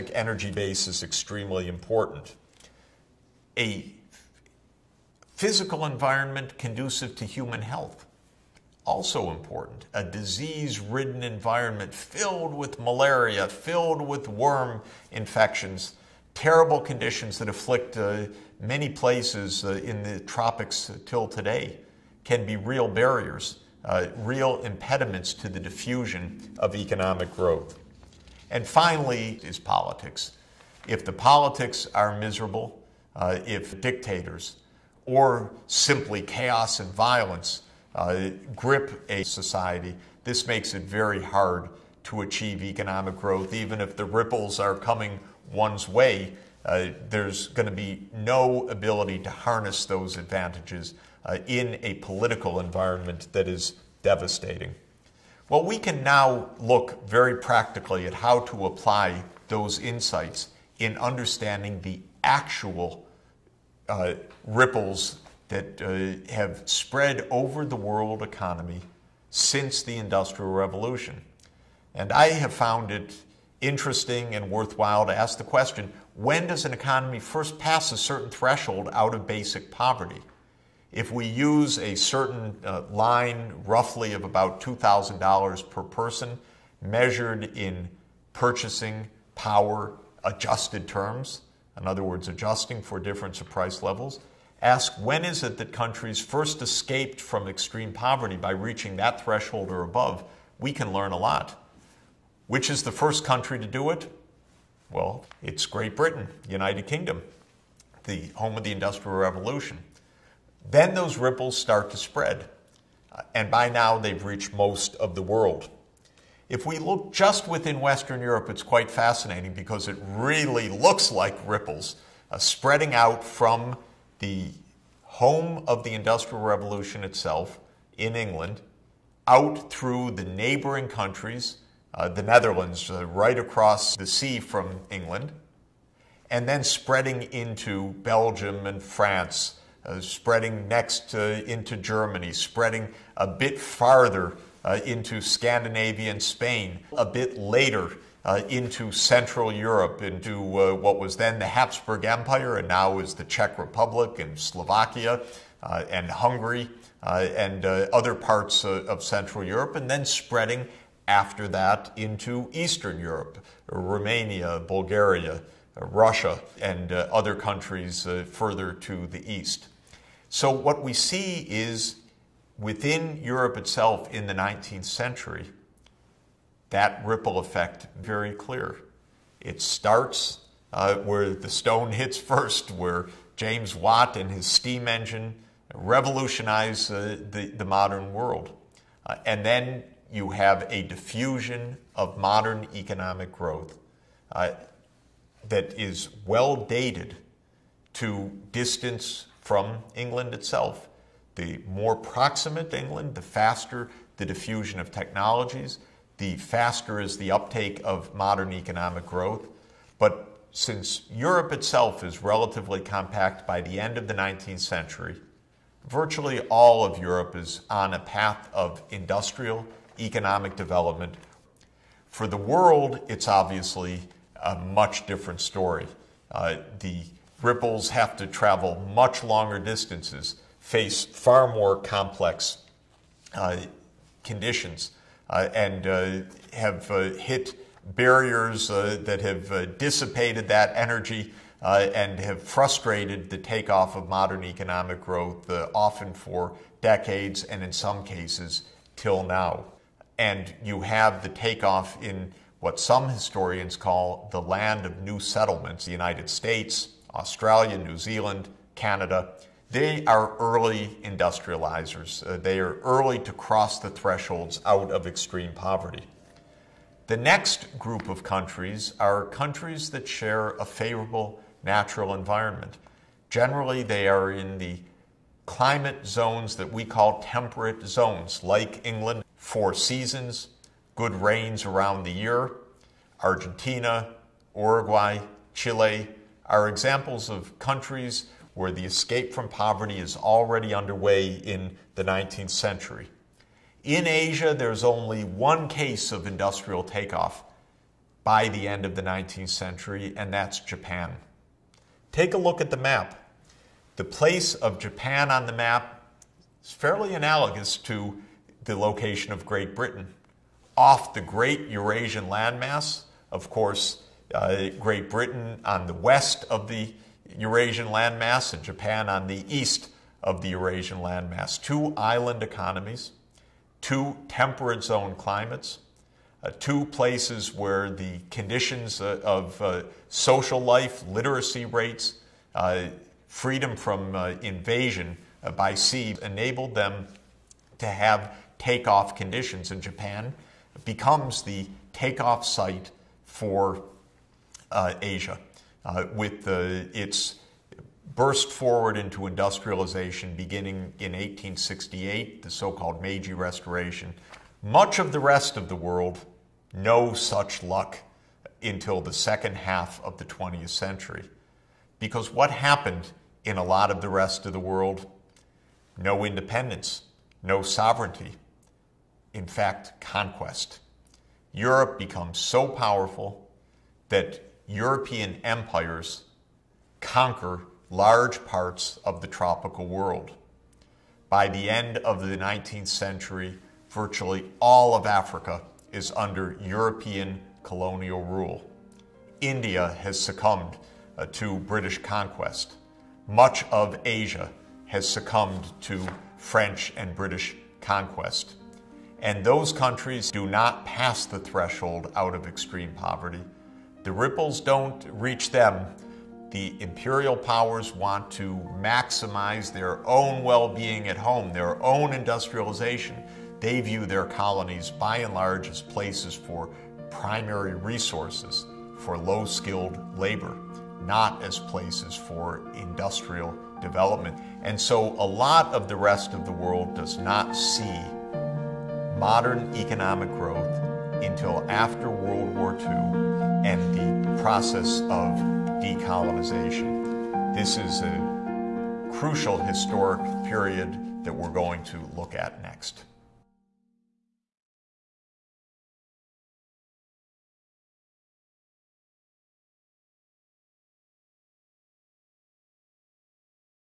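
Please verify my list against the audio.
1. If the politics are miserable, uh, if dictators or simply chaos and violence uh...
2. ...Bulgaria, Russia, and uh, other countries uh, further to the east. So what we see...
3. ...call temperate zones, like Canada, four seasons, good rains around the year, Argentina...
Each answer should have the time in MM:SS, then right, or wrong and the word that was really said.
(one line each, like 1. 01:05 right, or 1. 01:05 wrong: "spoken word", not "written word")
1. 00:30 right
2. 02:44 right
3. 04:36 wrong: "England", not "Canada".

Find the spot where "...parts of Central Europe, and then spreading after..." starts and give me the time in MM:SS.
02:38.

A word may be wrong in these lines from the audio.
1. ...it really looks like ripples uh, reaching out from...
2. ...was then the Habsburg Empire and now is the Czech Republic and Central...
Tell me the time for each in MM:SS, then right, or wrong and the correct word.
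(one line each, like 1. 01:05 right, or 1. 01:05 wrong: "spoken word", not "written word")
1. 01:59 wrong: "spreading", not "reaching"
2. 02:30 wrong: "Slovakia", not "Central".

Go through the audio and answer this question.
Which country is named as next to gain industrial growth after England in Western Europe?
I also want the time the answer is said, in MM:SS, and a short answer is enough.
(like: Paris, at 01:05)
The Netherlands, at 02:12.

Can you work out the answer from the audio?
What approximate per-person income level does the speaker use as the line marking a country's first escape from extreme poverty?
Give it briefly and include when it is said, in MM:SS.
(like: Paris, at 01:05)
$2,000, at 01:24.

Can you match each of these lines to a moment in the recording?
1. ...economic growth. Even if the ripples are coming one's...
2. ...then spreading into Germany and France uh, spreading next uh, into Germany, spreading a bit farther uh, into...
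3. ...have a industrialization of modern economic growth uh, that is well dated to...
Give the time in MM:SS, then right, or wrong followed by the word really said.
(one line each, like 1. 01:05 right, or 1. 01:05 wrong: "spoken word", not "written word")
1. 00:42 right
2. 02:16 wrong: "Belgium", not "Germany"
3. 03:10 wrong: "diffusion", not "industrialization".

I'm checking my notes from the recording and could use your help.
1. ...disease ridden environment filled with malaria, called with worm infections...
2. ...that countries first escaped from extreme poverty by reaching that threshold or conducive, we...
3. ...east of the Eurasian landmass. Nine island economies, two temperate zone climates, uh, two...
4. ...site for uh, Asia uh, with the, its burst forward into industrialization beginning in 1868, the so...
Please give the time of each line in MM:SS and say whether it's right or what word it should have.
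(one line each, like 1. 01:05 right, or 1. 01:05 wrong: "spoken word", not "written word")
1. 00:10 wrong: "filled", not "called"
2. 01:35 wrong: "above", not "conducive"
3. 05:19 wrong: "Two", not "Nine"
4. 05:42 right.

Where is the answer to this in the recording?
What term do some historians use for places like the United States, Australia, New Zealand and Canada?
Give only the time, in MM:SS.
04:14.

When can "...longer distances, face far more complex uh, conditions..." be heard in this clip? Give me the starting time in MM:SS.
03:49.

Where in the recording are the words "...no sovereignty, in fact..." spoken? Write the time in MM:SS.
06:07.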